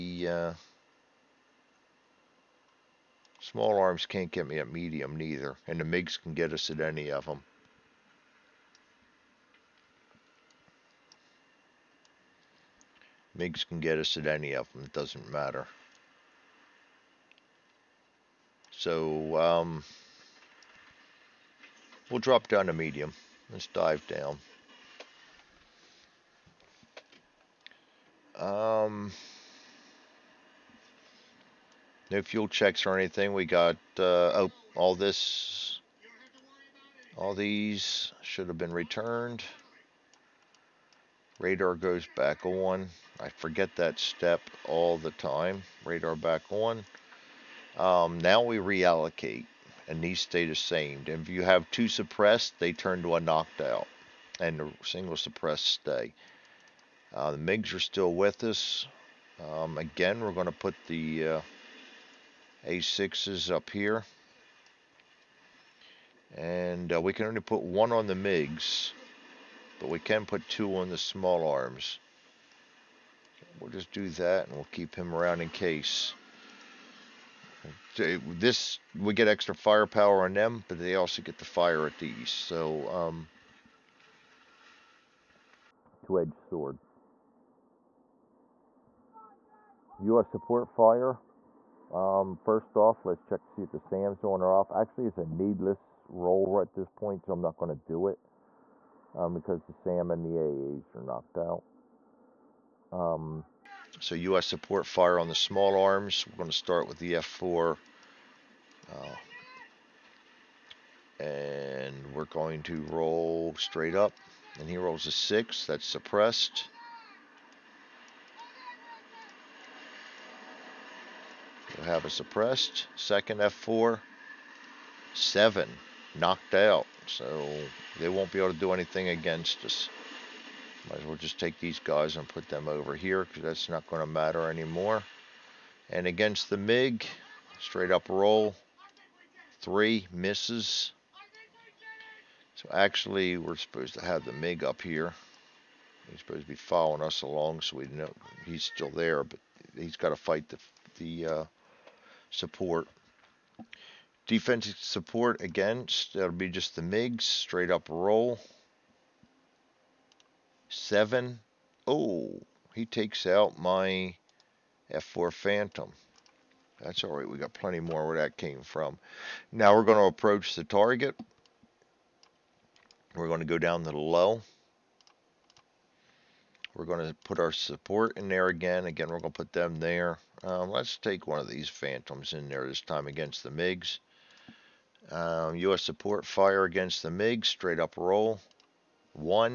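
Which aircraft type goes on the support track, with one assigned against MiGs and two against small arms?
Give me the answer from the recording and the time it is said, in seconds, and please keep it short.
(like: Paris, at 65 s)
A6s, at 62 s.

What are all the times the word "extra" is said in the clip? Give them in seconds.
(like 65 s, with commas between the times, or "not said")
79 s.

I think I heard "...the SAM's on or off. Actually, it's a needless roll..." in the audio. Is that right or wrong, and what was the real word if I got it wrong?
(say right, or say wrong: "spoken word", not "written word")
right.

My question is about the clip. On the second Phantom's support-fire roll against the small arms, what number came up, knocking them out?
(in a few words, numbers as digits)
7.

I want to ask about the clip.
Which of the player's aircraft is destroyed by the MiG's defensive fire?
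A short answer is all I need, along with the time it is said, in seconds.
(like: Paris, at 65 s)
F4 Phantom, at 164 s.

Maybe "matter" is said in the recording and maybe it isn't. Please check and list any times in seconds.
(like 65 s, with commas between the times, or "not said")
15 s, 134 s.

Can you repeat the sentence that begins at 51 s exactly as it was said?
If you have two suppressed, they turn to a knocked out, and the single suppressed stay.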